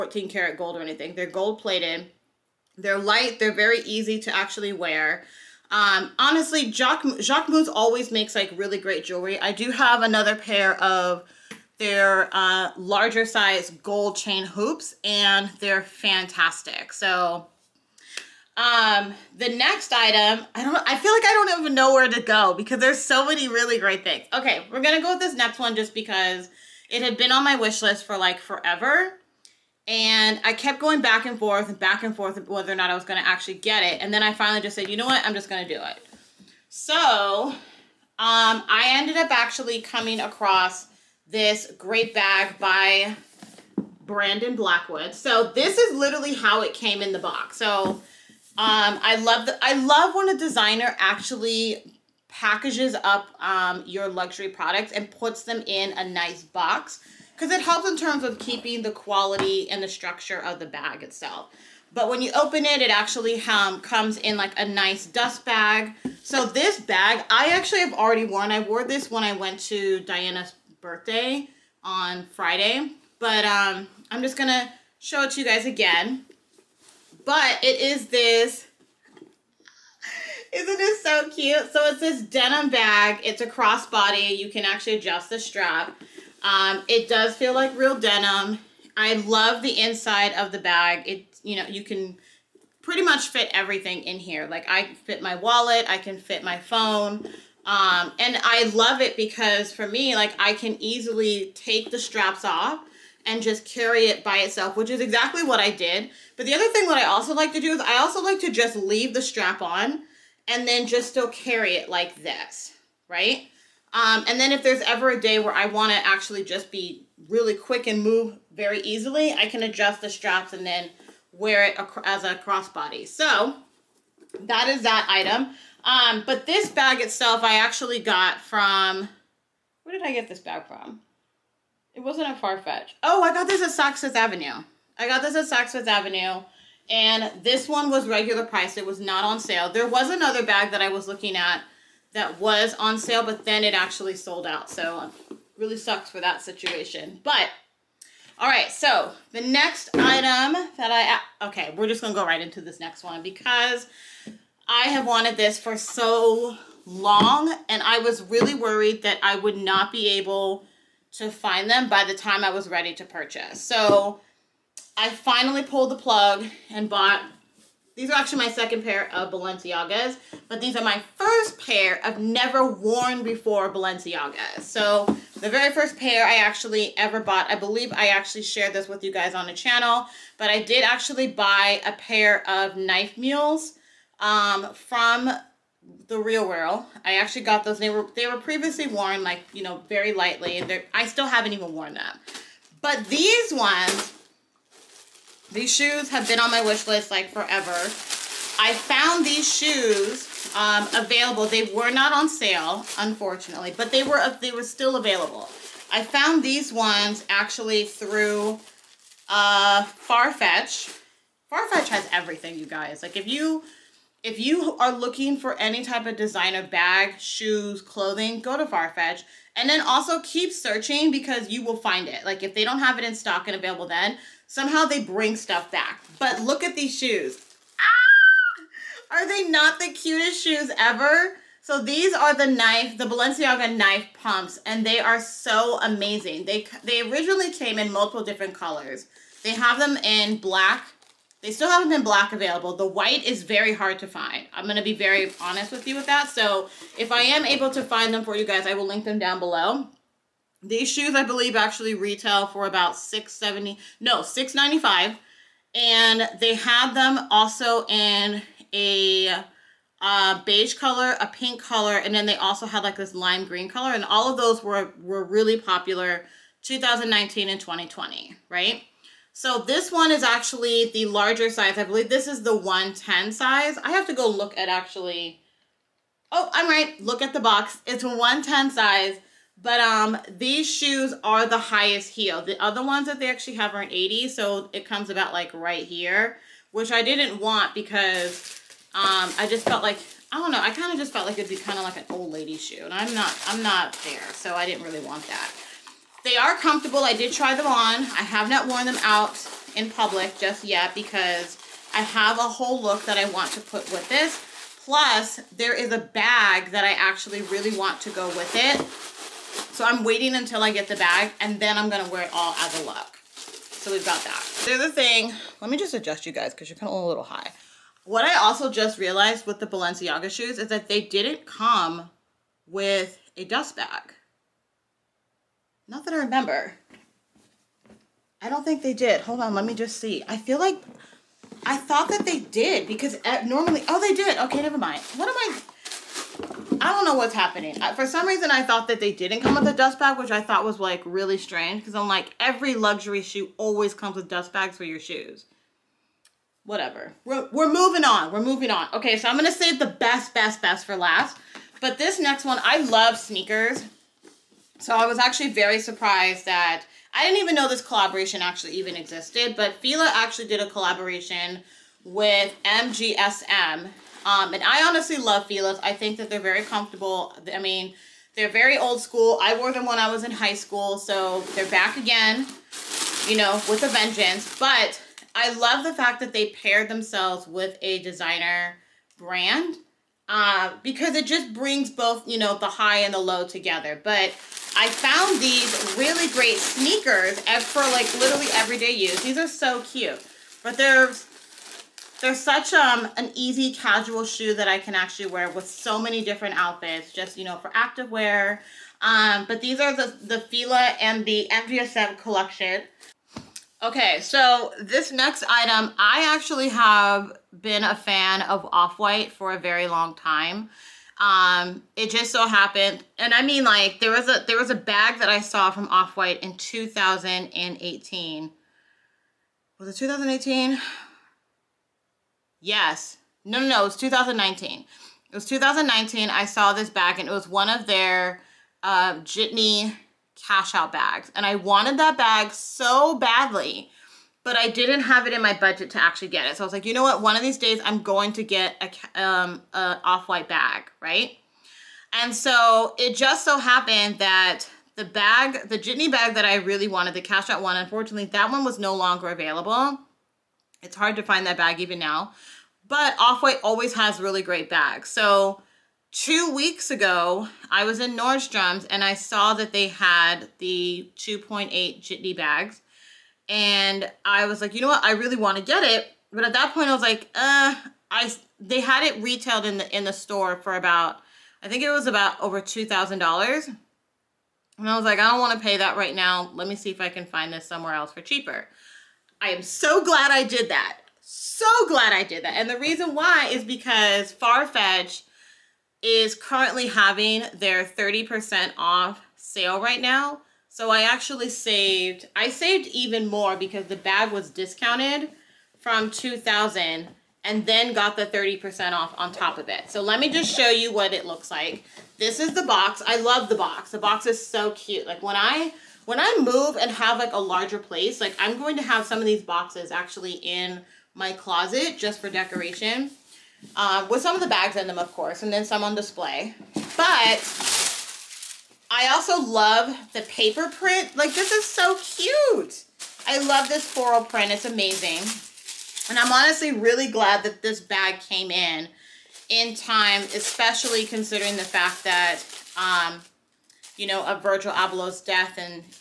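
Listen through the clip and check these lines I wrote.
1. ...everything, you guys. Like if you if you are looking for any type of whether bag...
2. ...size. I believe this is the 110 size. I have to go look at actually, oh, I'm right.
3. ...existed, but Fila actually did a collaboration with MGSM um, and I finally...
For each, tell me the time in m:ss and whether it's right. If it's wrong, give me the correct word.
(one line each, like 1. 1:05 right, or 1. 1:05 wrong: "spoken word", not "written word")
1. 3:32 wrong: "designer", not "whether"
2. 4:31 right
3. 5:58 wrong: "honestly", not "finally".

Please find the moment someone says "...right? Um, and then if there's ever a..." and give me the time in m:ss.
1:53.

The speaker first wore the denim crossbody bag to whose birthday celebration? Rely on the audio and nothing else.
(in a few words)
Diana's.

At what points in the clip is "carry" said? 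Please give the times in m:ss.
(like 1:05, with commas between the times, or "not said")
1:43, 1:51.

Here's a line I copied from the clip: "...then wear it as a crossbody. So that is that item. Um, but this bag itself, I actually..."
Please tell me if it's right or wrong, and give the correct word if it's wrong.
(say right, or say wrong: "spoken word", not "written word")
right.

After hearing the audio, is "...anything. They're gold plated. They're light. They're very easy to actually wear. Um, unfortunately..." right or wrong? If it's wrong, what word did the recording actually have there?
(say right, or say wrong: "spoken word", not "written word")
wrong: "honestly", not "unfortunately".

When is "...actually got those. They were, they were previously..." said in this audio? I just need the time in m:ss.
3:07.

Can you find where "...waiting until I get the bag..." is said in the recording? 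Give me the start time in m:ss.
5:10.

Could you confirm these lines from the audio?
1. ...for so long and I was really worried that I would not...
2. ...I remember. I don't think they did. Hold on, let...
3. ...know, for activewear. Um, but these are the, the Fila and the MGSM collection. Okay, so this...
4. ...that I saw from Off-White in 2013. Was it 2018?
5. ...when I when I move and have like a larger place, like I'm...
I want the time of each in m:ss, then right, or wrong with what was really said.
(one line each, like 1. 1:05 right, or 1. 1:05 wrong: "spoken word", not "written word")
1. 2:35 right
2. 5:26 right
3. 6:37 right
4. 6:55 wrong: "2018", not "2013"
5. 8:25 right.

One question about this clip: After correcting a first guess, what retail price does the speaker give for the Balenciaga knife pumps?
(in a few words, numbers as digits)
695.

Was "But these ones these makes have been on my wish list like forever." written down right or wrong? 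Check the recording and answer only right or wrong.
wrong.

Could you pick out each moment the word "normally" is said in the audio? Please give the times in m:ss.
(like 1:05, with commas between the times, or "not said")
5:33.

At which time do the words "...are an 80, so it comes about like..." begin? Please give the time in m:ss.
4:43.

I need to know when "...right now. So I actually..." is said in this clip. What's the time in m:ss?
8:09.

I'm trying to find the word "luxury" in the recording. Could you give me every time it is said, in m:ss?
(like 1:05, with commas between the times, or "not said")
0:54, 5:42.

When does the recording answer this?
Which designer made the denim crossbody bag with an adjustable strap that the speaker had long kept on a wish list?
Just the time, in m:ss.
0:44.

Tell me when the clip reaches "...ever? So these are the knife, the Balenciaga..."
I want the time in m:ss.
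3:50.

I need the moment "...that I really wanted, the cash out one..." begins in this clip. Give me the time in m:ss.
7:26.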